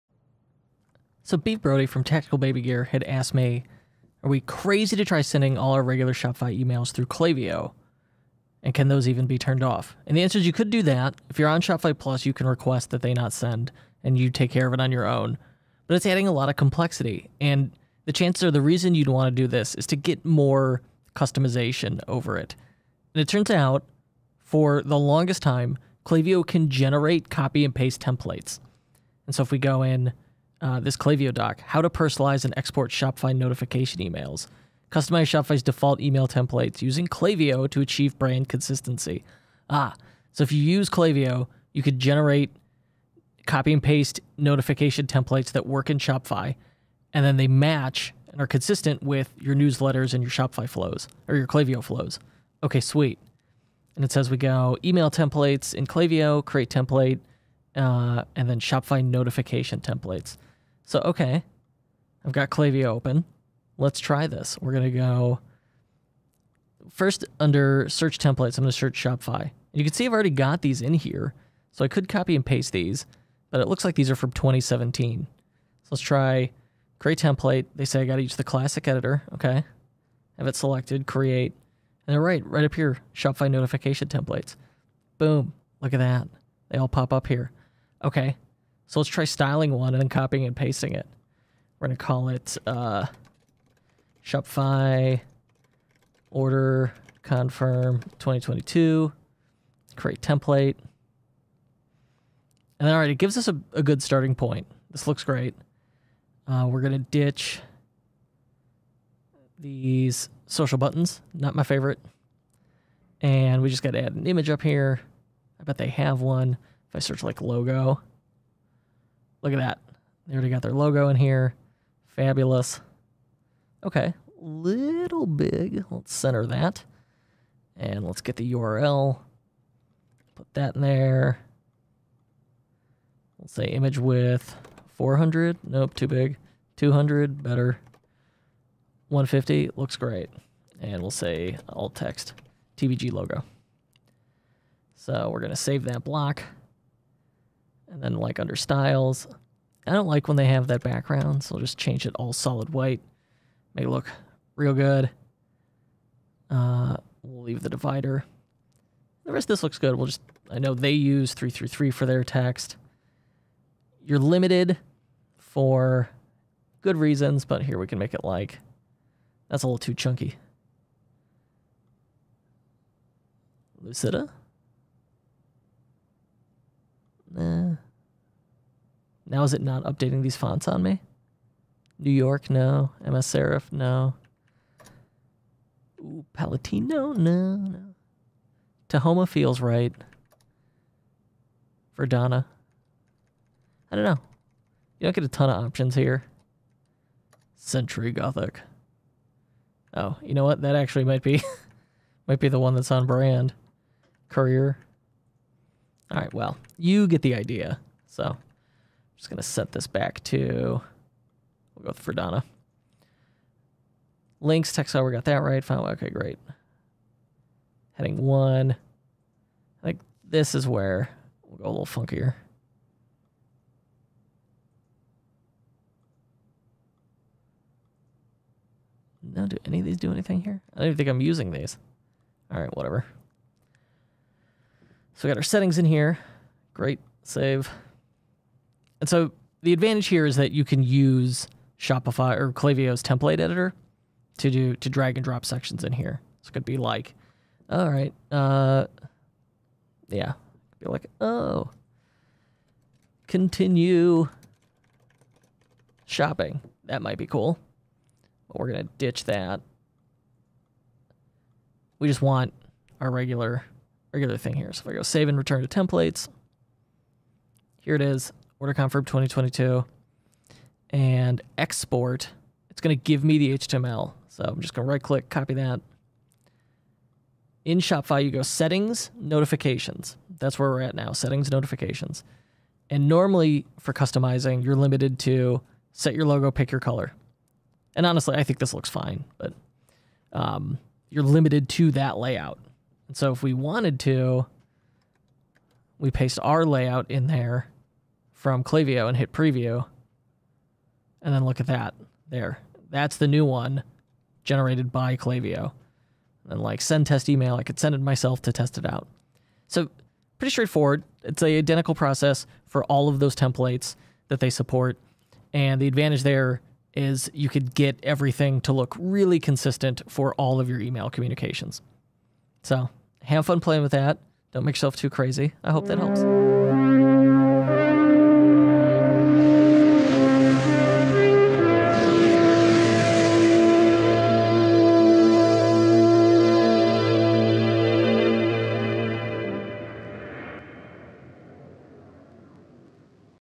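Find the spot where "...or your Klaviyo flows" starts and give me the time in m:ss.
0:51.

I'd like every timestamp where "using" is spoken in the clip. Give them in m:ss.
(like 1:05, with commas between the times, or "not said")
0:36, 3:51.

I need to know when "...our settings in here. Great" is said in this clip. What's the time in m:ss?
3:55.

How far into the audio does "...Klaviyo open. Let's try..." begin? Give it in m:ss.
1:02.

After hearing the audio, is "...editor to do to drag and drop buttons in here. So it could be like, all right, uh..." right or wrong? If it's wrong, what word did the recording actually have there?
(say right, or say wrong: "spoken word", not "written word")
wrong: "sections", not "buttons".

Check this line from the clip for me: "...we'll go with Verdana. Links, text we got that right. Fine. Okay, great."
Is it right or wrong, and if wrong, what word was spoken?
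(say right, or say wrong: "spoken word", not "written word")
right.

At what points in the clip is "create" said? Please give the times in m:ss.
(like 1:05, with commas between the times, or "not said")
0:56, 1:16, 1:21, 1:39.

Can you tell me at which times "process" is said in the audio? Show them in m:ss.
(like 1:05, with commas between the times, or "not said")
5:11.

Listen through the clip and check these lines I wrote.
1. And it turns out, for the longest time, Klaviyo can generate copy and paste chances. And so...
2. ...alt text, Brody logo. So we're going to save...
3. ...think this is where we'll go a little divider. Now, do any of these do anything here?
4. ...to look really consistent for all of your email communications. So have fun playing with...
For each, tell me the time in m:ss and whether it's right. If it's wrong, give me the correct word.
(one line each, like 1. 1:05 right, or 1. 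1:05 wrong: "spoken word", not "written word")
1. 0:23 wrong: "templates", not "chances"
2. 2:21 wrong: "TBG", not "Brody"
3. 3:39 wrong: "funkier", not "divider"
4. 5:18 right.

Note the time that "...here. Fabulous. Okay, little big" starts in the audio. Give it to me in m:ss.
2:01.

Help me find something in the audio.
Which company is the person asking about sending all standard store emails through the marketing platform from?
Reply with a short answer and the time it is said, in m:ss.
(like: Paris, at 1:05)
Tactical Baby Gear, at 0:02.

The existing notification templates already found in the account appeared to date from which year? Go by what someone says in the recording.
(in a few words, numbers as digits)
2017.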